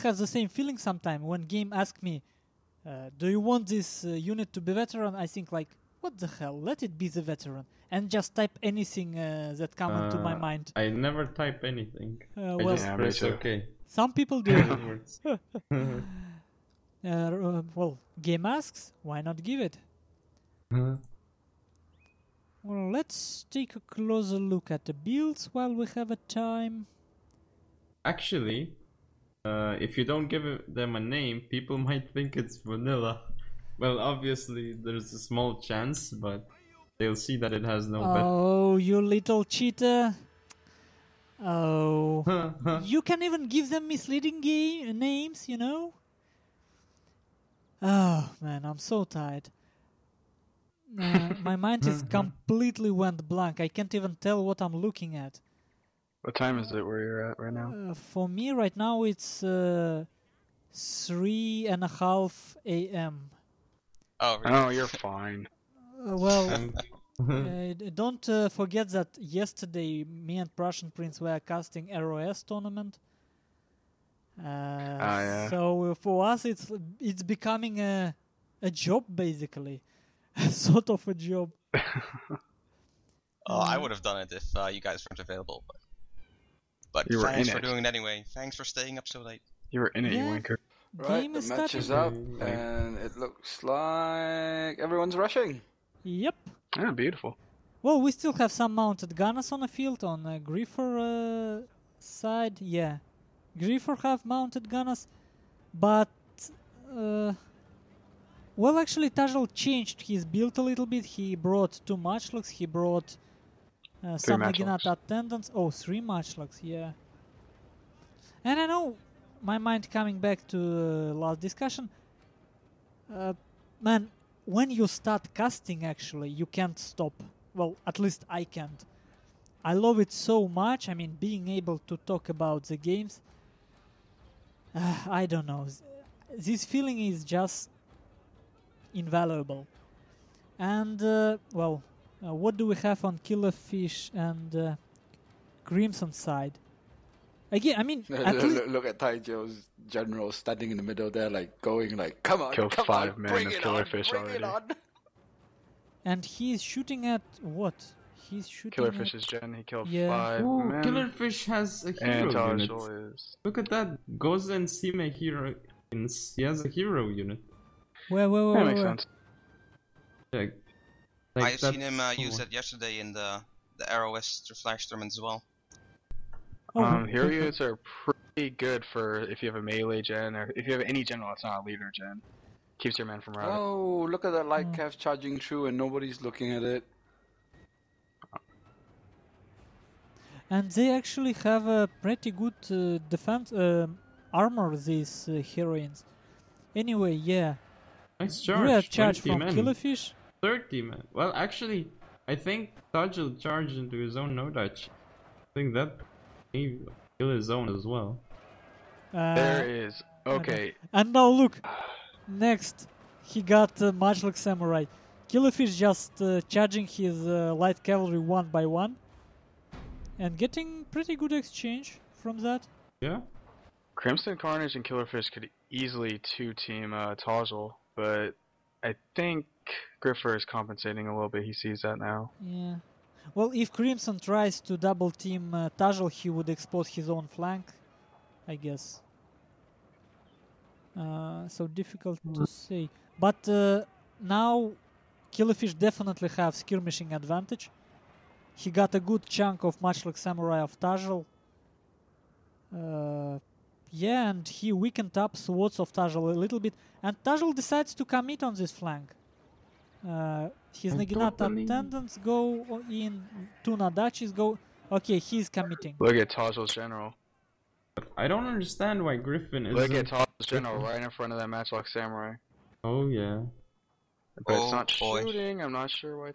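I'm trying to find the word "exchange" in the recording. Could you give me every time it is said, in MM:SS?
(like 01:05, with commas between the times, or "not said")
03:41.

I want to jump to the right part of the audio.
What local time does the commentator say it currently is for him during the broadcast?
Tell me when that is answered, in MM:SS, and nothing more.
01:00.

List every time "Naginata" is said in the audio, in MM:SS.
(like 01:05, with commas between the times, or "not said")
01:54, 04:20.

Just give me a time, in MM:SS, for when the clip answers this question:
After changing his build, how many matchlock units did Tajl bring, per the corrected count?
01:55.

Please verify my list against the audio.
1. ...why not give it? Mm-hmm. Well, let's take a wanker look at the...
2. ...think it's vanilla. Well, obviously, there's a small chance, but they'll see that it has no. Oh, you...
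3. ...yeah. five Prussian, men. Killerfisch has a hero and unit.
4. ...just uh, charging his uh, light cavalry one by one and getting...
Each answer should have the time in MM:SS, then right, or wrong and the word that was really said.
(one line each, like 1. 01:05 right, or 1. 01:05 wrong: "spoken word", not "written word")
1. 00:19 wrong: "closer", not "wanker"
2. 00:32 right
3. 02:39 wrong: "Ooh", not "Prussian"
4. 03:35 right.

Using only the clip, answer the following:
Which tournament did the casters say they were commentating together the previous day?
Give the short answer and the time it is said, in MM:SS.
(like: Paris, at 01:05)
ROS tournament, at 01:11.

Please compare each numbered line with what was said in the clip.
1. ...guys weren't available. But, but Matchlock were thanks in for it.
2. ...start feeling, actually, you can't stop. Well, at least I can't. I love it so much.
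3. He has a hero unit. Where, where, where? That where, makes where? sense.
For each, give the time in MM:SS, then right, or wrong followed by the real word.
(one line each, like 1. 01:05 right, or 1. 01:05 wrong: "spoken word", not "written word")
1. 01:24 wrong: "You", not "Matchlock"
2. 02:04 wrong: "casting", not "feeling"
3. 02:46 right.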